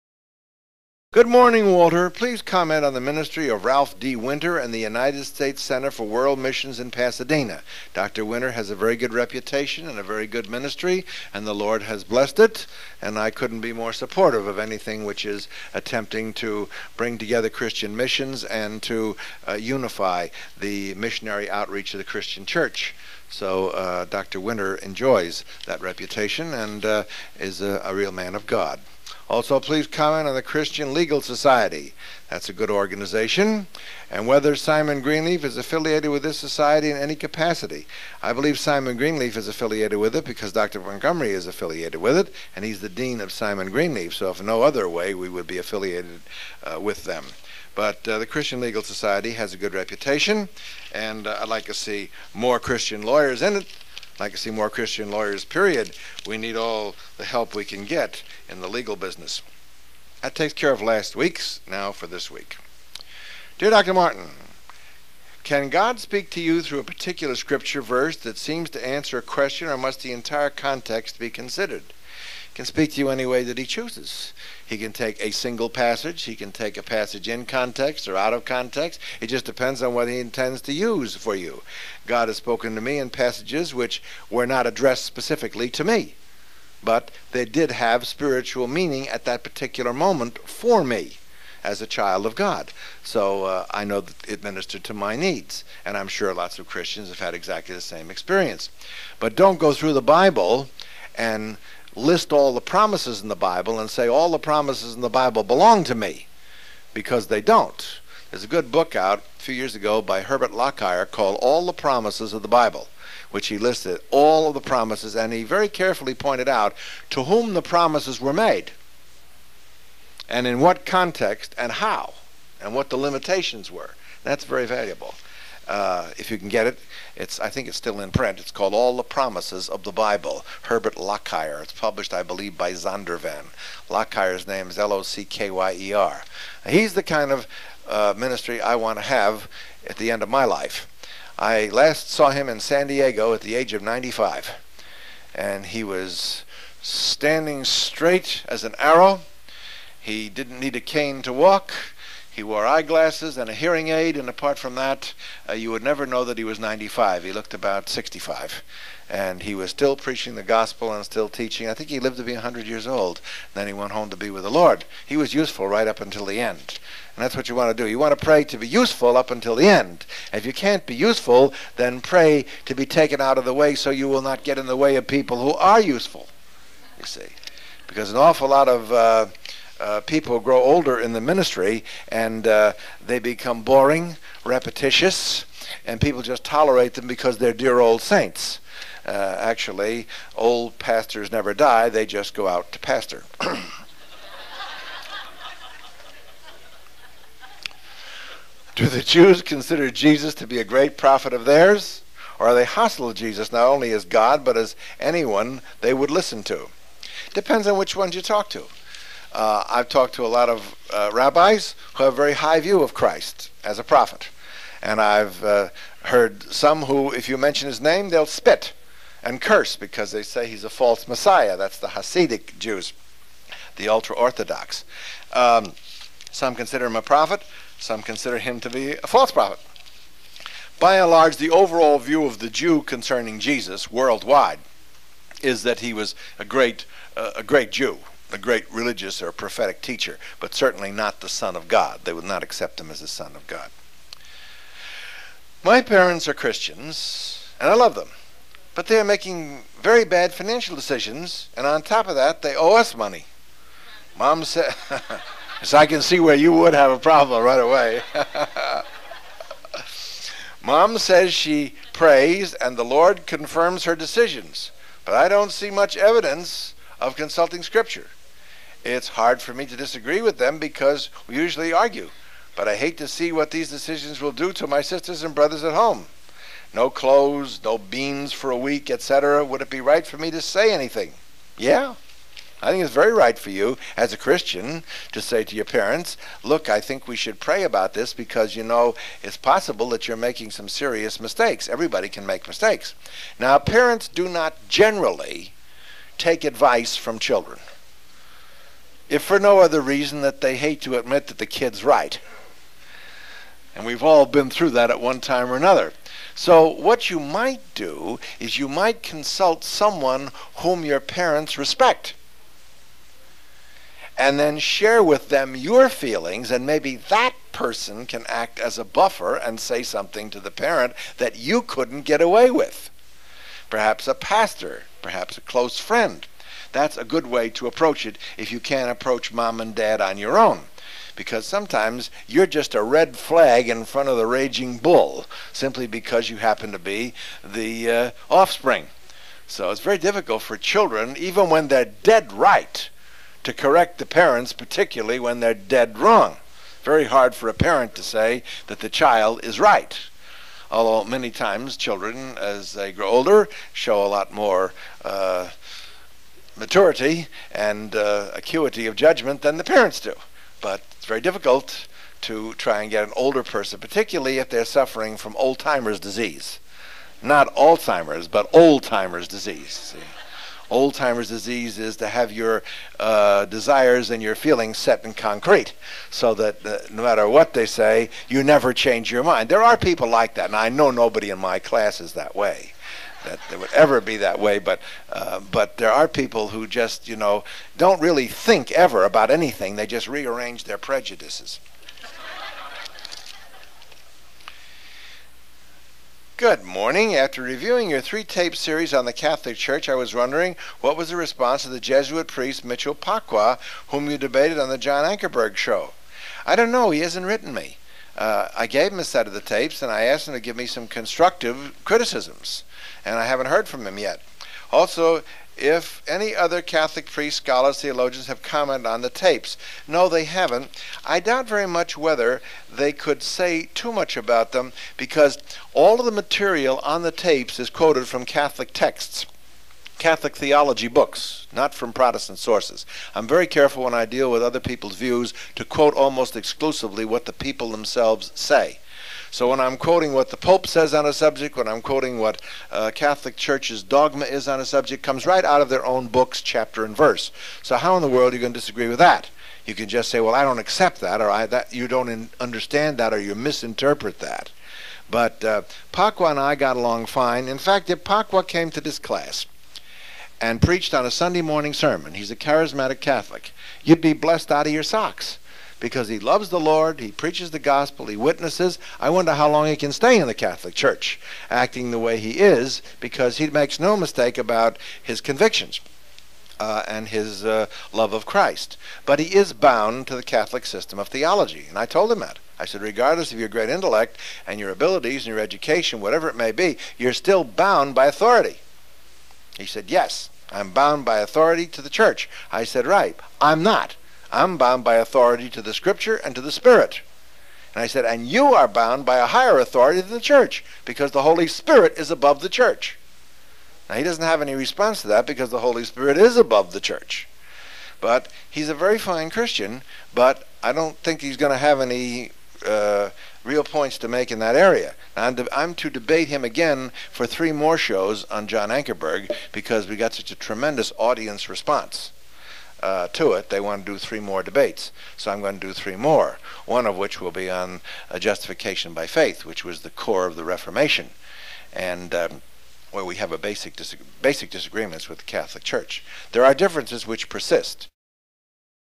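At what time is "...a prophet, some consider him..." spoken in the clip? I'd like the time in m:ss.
3:46.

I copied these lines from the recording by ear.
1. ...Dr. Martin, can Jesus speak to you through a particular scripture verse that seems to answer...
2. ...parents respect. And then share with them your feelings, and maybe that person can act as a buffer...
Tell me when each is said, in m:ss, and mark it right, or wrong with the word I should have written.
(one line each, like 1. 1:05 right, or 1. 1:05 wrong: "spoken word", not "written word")
1. 1:03 wrong: "God", not "Jesus"
2. 5:11 right.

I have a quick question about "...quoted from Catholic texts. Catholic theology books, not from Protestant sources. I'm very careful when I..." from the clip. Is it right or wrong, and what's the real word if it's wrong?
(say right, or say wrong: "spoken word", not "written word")
right.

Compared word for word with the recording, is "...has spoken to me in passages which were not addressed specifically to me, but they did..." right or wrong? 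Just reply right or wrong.
right.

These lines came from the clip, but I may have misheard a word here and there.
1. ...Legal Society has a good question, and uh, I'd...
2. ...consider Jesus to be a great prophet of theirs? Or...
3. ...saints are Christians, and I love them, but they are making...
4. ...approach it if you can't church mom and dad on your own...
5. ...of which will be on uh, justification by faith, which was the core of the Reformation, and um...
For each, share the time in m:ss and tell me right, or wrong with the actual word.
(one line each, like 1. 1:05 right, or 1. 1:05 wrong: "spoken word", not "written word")
1. 0:48 wrong: "reputation", not "question"
2. 3:19 right
3. 4:05 wrong: "parents", not "saints"
4. 5:27 wrong: "approach", not "church"
5. 8:46 right.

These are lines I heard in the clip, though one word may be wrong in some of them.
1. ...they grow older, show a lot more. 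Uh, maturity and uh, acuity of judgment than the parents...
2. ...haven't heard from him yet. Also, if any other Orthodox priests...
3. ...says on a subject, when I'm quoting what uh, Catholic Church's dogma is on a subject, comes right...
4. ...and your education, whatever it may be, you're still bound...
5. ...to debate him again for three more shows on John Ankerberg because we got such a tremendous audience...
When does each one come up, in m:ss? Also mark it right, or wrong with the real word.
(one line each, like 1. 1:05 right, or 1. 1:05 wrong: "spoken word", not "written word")
1. 5:52 right
2. 6:53 wrong: "Catholic", not "Orthodox"
3. 7:20 right
4. 8:05 right
5. 8:35 right.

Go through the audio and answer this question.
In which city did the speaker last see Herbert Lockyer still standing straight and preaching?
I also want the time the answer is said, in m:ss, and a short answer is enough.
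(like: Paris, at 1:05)
San Diego, at 2:22.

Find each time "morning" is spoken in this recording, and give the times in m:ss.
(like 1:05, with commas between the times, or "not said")
0:01, 6:36, 7:41.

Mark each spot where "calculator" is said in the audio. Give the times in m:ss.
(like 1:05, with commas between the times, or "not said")
not said.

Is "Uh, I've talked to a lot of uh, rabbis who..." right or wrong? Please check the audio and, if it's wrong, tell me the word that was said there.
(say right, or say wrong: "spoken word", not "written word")
right.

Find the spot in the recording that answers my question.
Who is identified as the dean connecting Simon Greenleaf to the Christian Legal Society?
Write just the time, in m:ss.
0:40.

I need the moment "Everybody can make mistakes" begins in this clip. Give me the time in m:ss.
4:51.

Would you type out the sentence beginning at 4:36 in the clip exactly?
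No clothes, no beans for a week, etc.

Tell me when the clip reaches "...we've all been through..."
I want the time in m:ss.
5:03.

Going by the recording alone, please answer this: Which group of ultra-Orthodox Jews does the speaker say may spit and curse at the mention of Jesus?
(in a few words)
Hasidic Jews.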